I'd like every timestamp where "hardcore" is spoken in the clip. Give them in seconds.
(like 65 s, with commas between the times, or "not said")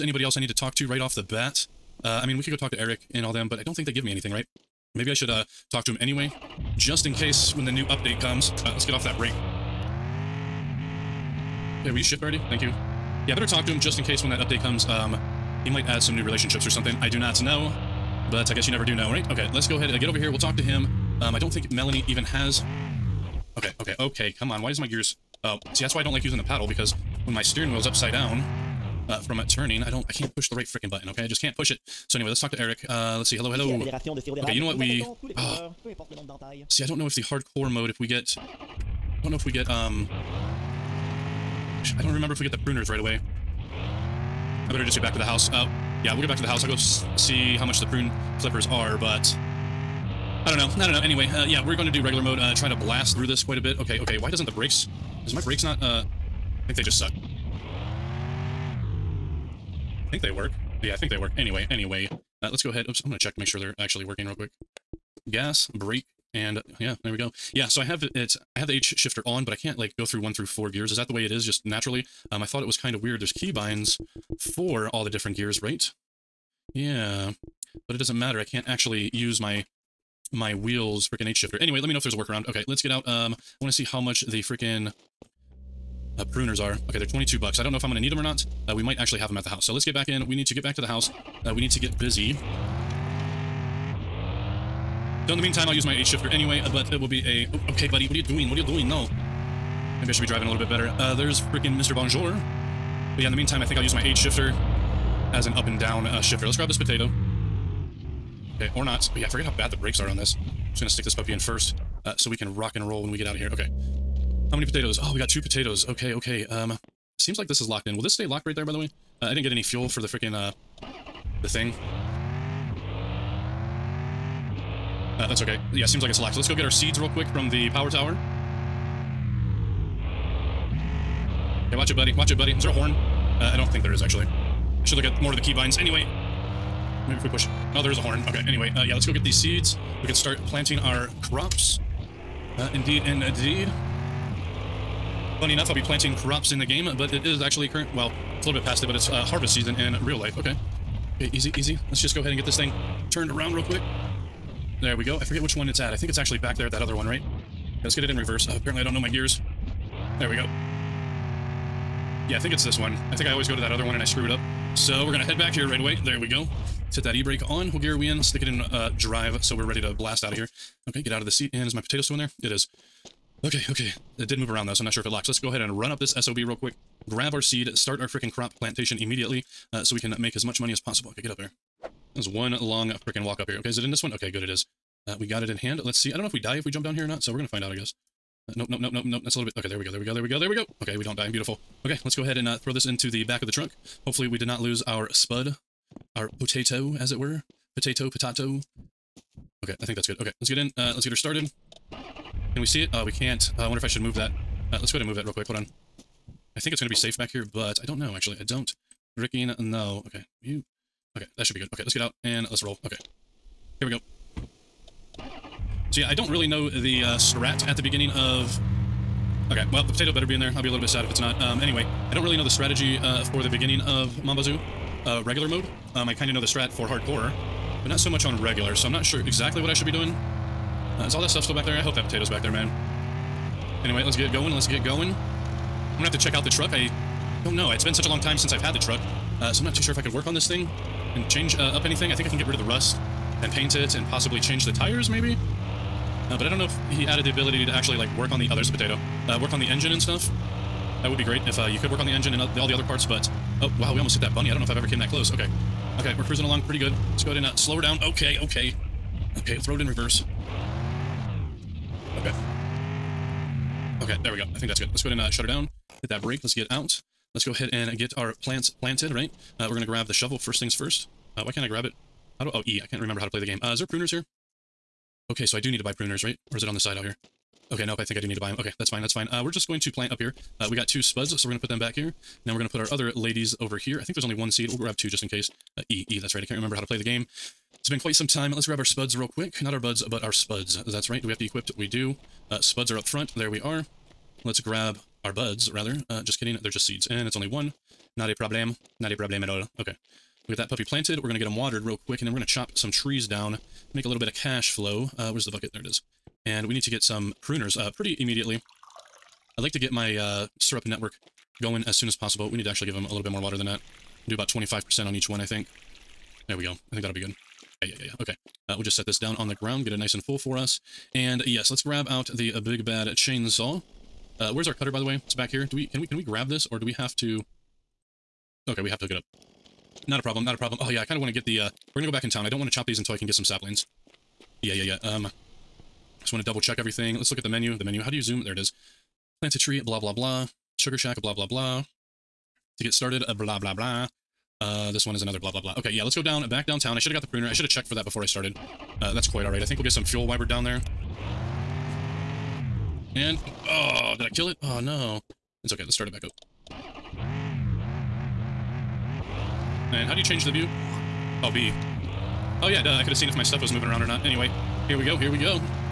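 37 s, 226 s.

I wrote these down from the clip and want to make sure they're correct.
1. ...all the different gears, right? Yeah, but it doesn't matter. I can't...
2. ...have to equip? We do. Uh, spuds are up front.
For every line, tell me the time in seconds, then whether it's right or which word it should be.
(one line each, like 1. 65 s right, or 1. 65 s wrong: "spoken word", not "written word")
1. 74 s right
2. 291 s right.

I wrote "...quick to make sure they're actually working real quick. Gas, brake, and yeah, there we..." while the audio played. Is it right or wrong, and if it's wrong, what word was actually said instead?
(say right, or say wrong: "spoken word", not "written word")
wrong: "check", not "quick".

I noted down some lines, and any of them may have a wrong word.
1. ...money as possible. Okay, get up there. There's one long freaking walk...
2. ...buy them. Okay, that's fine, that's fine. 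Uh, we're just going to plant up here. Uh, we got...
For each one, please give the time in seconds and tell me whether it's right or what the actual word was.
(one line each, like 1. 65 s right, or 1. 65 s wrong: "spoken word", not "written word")
1. 180 s right
2. 278 s right.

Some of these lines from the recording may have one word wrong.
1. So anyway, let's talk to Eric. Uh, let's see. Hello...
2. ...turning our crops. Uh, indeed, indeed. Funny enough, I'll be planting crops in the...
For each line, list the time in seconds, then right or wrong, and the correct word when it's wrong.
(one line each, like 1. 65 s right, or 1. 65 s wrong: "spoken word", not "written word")
1. 32 s right
2. 140 s wrong: "planting", not "turning".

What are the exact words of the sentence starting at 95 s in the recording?
So in the meantime, I'll use my H-shifter anyway, uh, but it will be a...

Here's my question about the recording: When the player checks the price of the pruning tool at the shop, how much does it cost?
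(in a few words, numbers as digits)
22 bucks.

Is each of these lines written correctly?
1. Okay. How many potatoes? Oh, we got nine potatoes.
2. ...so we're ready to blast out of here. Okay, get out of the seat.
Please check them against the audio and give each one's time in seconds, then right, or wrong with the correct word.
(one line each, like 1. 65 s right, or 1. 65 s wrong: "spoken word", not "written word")
1. 113 s wrong: "two", not "nine"
2. 169 s right.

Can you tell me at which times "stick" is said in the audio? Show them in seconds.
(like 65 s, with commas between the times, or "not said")
110 s, 168 s.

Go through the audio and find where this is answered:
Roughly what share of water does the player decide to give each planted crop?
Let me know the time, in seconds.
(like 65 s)
314 s.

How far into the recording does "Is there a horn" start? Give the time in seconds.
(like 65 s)
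132 s.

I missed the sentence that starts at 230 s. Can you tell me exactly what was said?
Uh, is all that stuff still back there?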